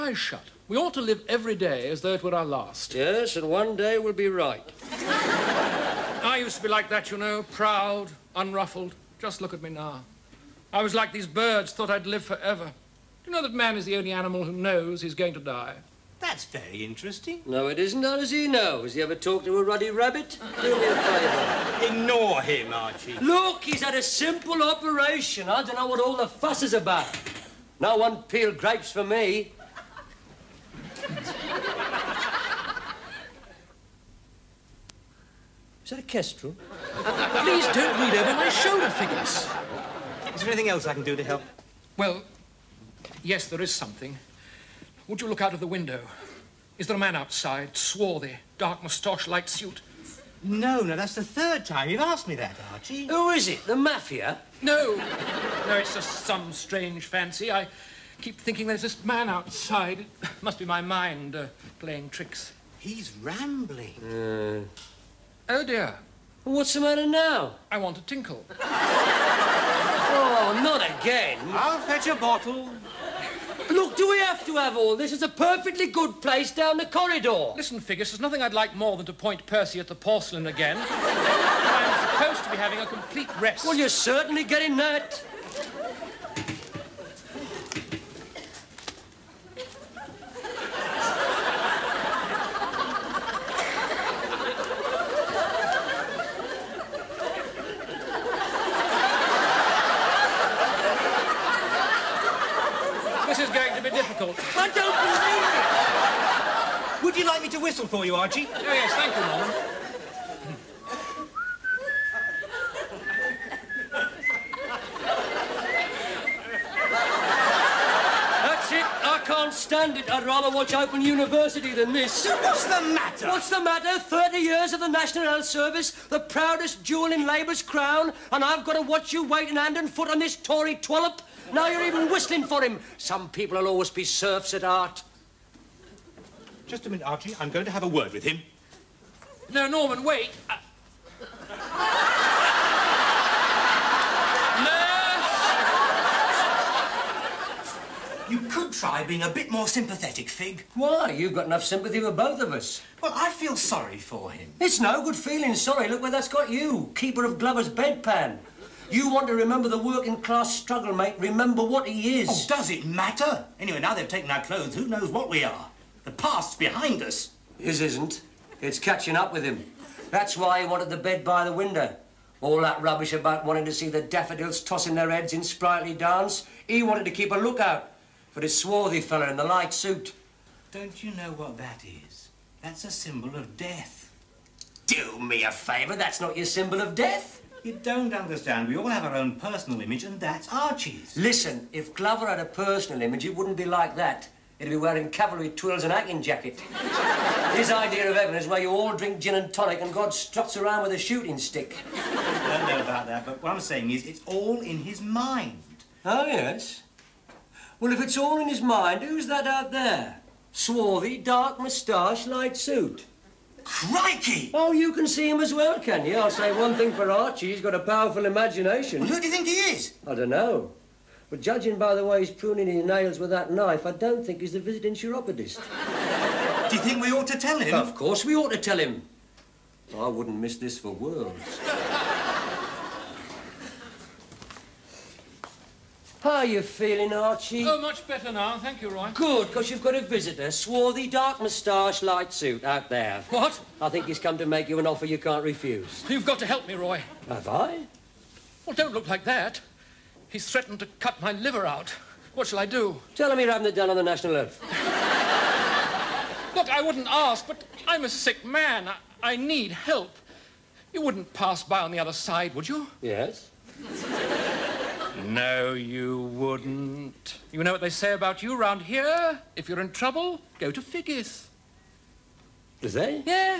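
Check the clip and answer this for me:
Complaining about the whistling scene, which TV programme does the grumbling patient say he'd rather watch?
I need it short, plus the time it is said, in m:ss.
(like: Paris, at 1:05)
Open University, at 2:00.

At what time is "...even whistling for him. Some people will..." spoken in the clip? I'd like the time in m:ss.
2:11.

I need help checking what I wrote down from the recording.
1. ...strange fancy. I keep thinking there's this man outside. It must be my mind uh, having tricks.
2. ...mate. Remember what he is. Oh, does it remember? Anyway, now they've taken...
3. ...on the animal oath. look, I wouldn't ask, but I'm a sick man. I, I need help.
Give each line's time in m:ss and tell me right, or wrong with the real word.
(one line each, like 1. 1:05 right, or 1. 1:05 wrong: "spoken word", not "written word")
1. 0:56 wrong: "playing", not "having"
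2. 2:40 wrong: "matter", not "remember"
3. 4:13 wrong: "national", not "animal".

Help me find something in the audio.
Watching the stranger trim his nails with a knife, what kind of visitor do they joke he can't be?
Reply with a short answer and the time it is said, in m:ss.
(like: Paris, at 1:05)
chiropodist, at 3:44.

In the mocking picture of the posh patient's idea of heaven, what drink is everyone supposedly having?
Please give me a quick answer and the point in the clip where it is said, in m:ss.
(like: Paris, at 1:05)
gin and tonic, at 3:19.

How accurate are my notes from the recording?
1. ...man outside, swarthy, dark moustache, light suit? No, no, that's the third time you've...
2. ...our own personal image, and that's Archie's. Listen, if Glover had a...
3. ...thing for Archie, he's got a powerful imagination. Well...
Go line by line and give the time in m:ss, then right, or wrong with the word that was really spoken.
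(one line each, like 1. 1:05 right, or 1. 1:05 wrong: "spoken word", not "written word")
1. 0:46 right
2. 3:09 right
3. 3:36 right.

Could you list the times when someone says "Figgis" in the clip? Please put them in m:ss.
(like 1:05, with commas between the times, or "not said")
0:38, 1:17, 4:30.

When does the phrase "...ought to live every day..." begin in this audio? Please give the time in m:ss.
0:00.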